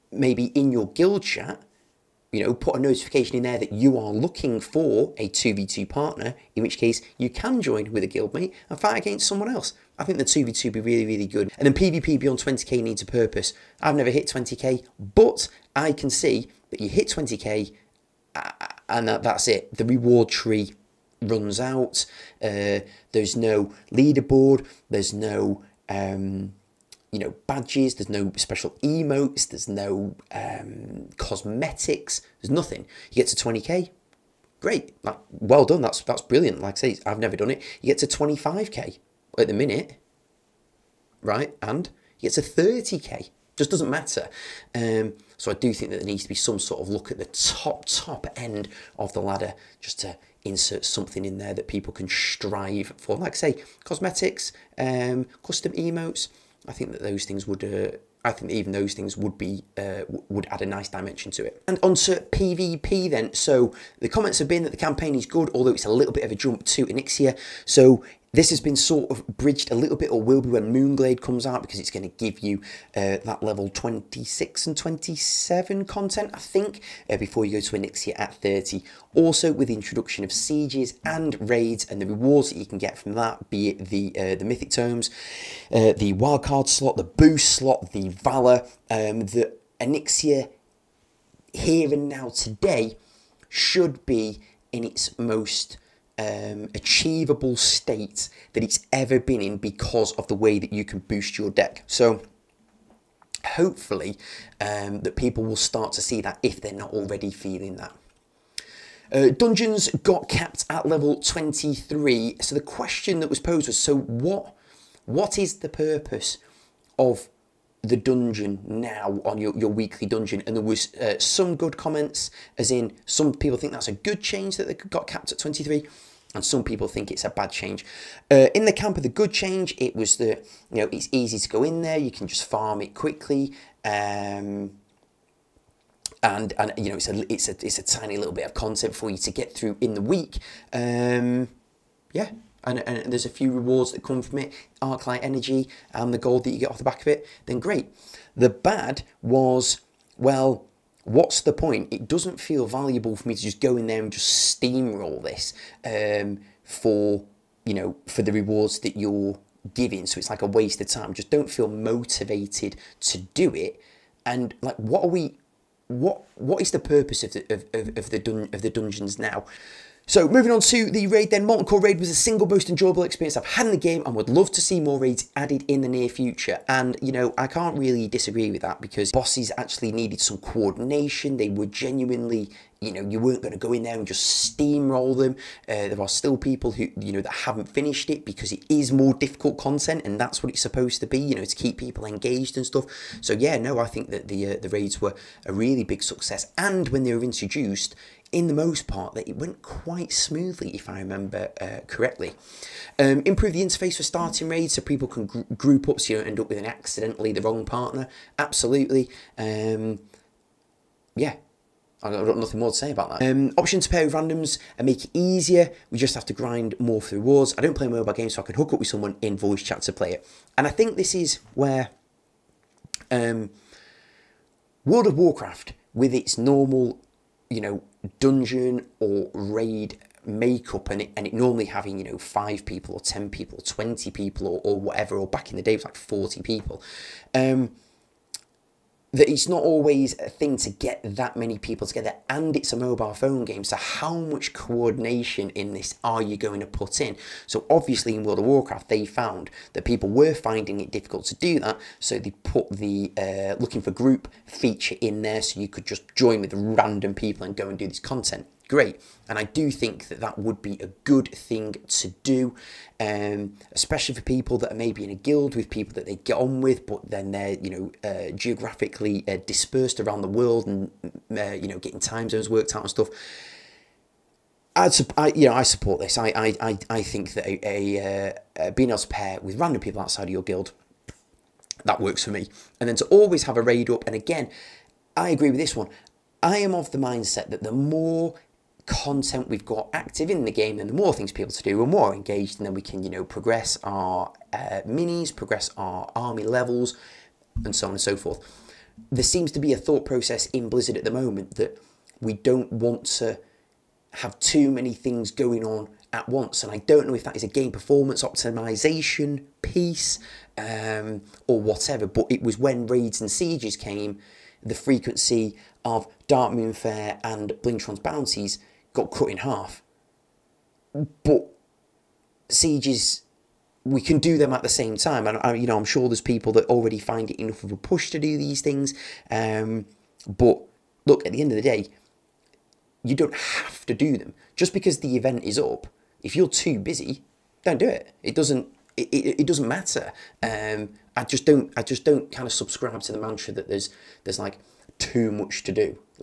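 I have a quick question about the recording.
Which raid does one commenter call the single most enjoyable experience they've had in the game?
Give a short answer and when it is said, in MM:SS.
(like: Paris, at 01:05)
Molten Core, at 02:51.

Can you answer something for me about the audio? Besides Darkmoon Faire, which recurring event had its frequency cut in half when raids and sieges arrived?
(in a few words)
Blingtron's bounties.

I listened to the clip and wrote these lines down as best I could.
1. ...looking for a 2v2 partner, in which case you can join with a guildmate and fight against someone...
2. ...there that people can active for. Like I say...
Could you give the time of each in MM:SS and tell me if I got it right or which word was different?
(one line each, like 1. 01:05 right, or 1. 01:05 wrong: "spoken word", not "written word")
1. 00:04 right
2. 00:51 wrong: "strive", not "active".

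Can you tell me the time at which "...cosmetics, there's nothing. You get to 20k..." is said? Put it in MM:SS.
00:31.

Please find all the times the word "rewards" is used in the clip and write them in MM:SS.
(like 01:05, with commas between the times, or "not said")
00:19, 01:22, 02:23, 02:38, 03:37.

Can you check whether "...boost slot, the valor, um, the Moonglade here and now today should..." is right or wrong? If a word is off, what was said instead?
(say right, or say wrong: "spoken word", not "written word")
wrong: "Onyxia", not "Moonglade".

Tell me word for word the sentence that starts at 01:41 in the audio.
So hopefully um, that people will start to see that if they're not already feeling that.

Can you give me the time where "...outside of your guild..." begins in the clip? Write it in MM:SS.
04:40.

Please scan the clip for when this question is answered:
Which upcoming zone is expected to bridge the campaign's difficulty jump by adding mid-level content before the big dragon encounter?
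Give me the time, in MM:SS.
01:10.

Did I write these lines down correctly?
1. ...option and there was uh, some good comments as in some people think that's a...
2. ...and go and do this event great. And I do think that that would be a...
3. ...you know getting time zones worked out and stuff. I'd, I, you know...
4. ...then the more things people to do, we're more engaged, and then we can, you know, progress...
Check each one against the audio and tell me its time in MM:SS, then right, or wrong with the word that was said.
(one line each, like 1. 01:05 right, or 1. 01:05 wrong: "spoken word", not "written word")
1. 02:00 wrong: "dungeon", not "option"
2. 04:17 wrong: "content", not "event"
3. 04:31 right
4. 04:50 right.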